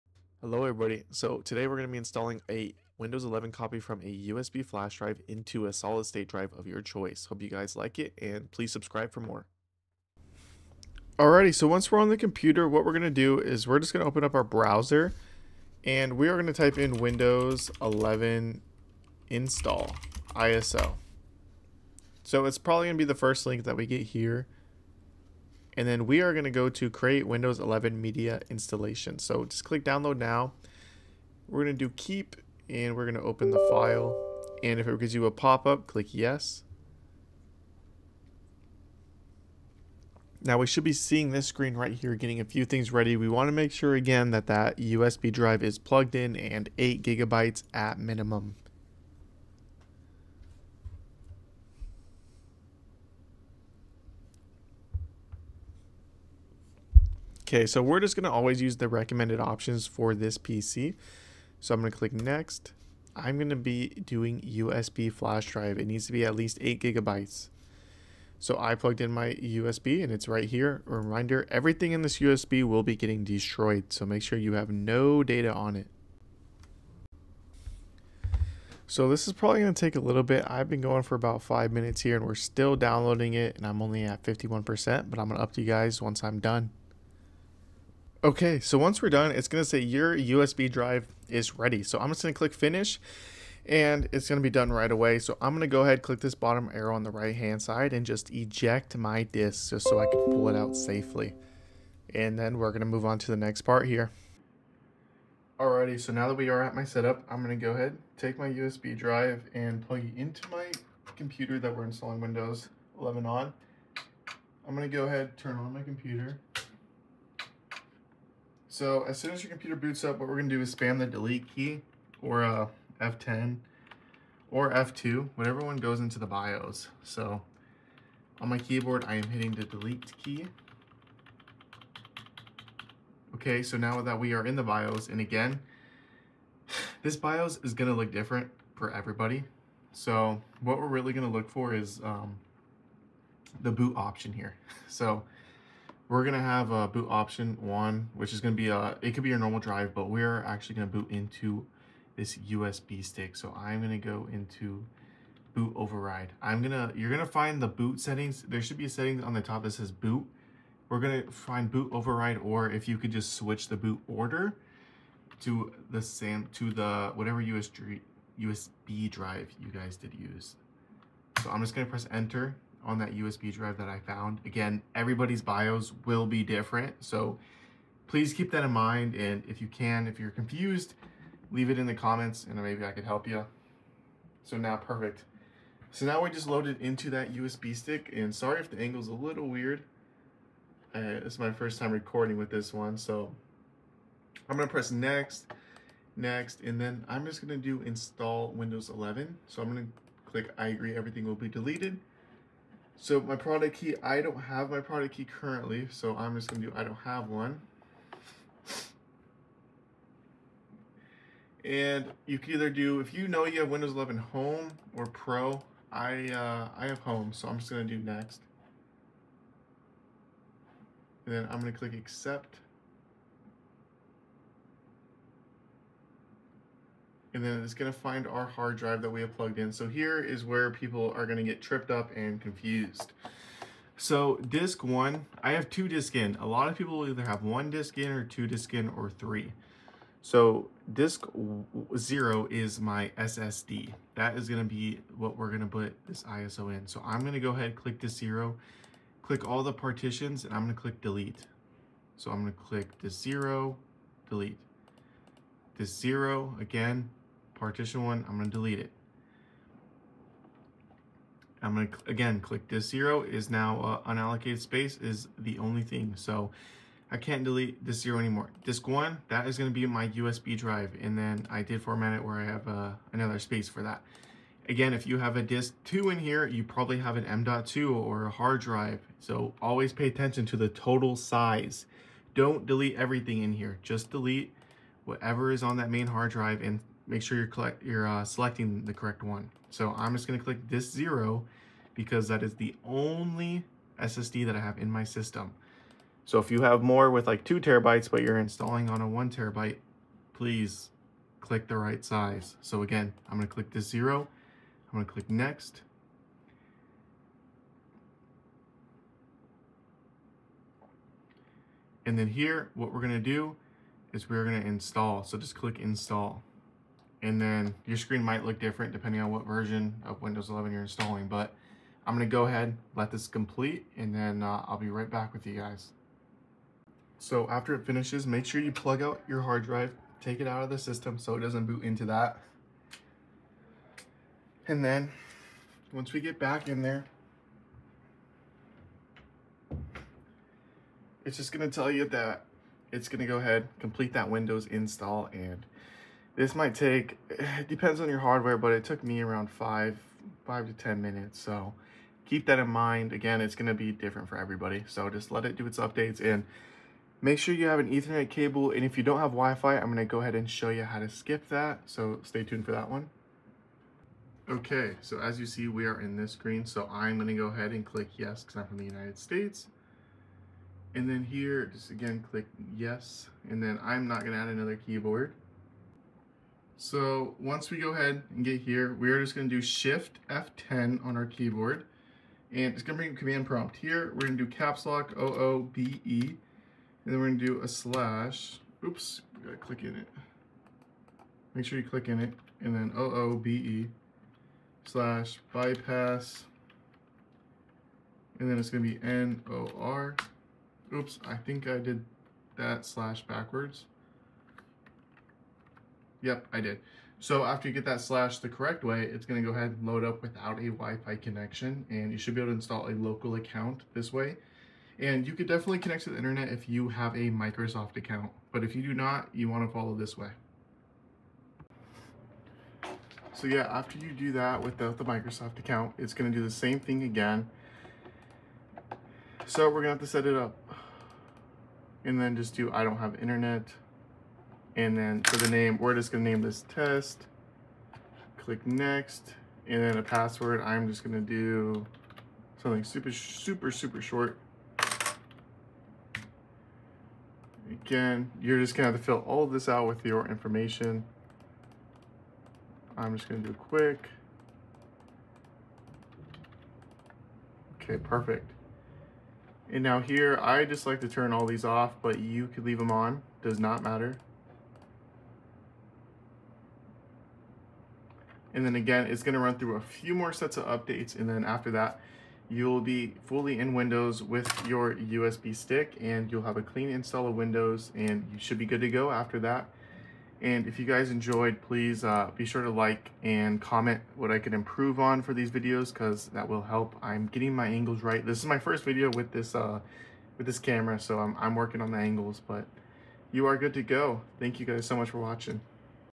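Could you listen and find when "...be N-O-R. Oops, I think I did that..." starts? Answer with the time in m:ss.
6:38.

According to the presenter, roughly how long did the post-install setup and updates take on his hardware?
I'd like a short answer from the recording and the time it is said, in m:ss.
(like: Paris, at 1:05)
5 to 10 minutes, at 5:50.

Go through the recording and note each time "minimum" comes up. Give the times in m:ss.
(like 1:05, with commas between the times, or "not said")
0:47.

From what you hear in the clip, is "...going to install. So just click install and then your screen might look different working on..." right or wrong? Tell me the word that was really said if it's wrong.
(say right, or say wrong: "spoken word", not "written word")
wrong: "depending", not "working".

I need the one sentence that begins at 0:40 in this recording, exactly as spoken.
Now we should be seeing this screen right here getting a few things ready.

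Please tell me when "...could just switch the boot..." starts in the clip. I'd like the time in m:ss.
2:42.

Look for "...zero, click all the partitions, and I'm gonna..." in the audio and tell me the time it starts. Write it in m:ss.
4:08.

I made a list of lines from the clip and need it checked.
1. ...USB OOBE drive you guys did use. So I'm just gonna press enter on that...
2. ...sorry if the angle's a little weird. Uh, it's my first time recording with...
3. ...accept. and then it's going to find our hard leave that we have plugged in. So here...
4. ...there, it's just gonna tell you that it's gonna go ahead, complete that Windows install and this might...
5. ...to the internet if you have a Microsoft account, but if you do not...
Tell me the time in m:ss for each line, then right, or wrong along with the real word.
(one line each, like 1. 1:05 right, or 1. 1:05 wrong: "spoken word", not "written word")
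1. 2:47 wrong: "USB", not "OOBE"
2. 3:08 right
3. 3:41 wrong: "drive", not "leave"
4. 5:36 right
5. 6:56 right.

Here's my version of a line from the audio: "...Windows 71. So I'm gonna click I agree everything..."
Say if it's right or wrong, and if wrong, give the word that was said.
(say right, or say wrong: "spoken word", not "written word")
wrong: "11", not "71".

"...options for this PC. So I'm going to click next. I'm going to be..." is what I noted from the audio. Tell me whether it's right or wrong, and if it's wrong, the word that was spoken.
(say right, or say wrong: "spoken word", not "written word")
right.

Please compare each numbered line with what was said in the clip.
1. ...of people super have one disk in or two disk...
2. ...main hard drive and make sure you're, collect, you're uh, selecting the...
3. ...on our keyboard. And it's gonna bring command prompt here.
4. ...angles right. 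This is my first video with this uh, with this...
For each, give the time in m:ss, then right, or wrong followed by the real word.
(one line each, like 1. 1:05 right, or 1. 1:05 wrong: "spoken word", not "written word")
1. 3:56 wrong: "either", not "super"
2. 4:45 right
3. 6:21 right
4. 8:07 right.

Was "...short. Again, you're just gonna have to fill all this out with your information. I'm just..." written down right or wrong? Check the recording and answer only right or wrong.
right.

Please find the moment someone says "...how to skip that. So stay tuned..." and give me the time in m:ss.
6:00.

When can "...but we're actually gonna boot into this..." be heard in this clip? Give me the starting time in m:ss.
2:29.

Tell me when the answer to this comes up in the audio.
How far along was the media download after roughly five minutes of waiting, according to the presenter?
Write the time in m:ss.
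1:24.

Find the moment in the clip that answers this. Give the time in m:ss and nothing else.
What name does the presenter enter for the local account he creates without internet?
7:16.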